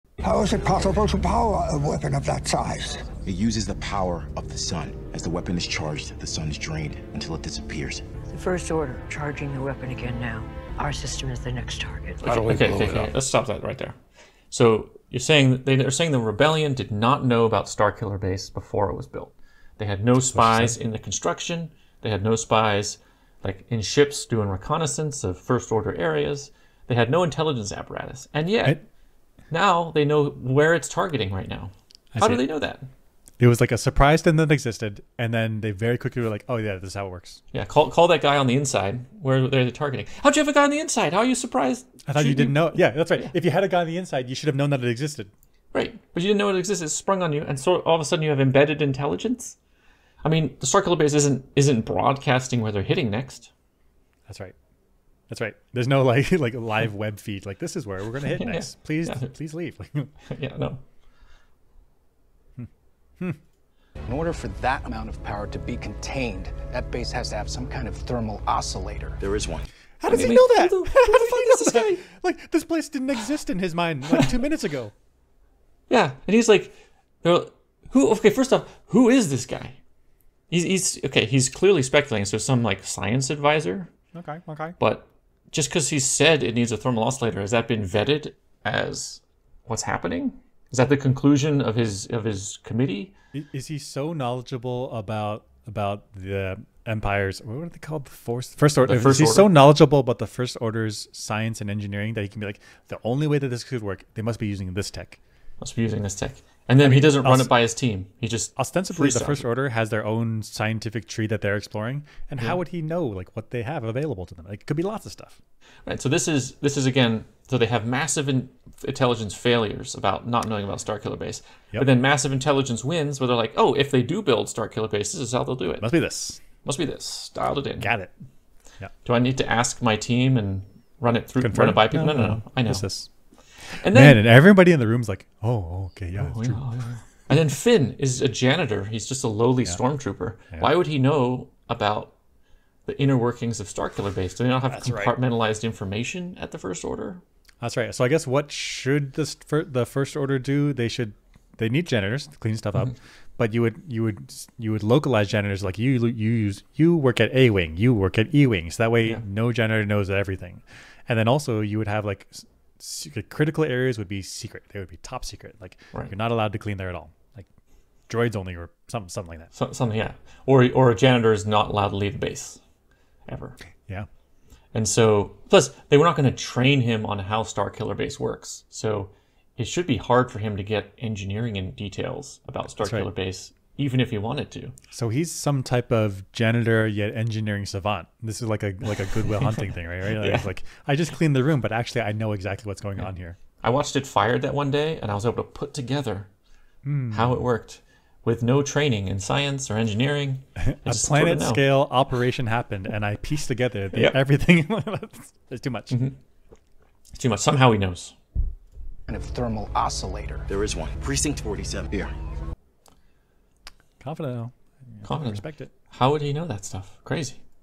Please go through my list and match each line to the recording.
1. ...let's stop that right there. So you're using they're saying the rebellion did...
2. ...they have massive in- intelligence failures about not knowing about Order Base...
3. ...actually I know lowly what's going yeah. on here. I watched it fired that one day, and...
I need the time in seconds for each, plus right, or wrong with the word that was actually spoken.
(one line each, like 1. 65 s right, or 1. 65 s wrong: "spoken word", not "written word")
1. 13 s wrong: "saying", not "using"
2. 117 s wrong: "Starkiller", not "Order"
3. 191 s wrong: "exactly", not "lowly".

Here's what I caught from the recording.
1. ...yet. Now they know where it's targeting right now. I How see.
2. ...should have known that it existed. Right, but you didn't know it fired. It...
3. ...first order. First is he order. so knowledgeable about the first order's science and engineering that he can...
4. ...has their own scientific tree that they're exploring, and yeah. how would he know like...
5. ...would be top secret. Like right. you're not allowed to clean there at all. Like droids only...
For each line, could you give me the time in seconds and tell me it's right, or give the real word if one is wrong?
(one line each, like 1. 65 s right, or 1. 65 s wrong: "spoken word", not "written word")
1. 28 s right
2. 44 s wrong: "existed", not "fired"
3. 98 s right
4. 109 s right
5. 164 s right.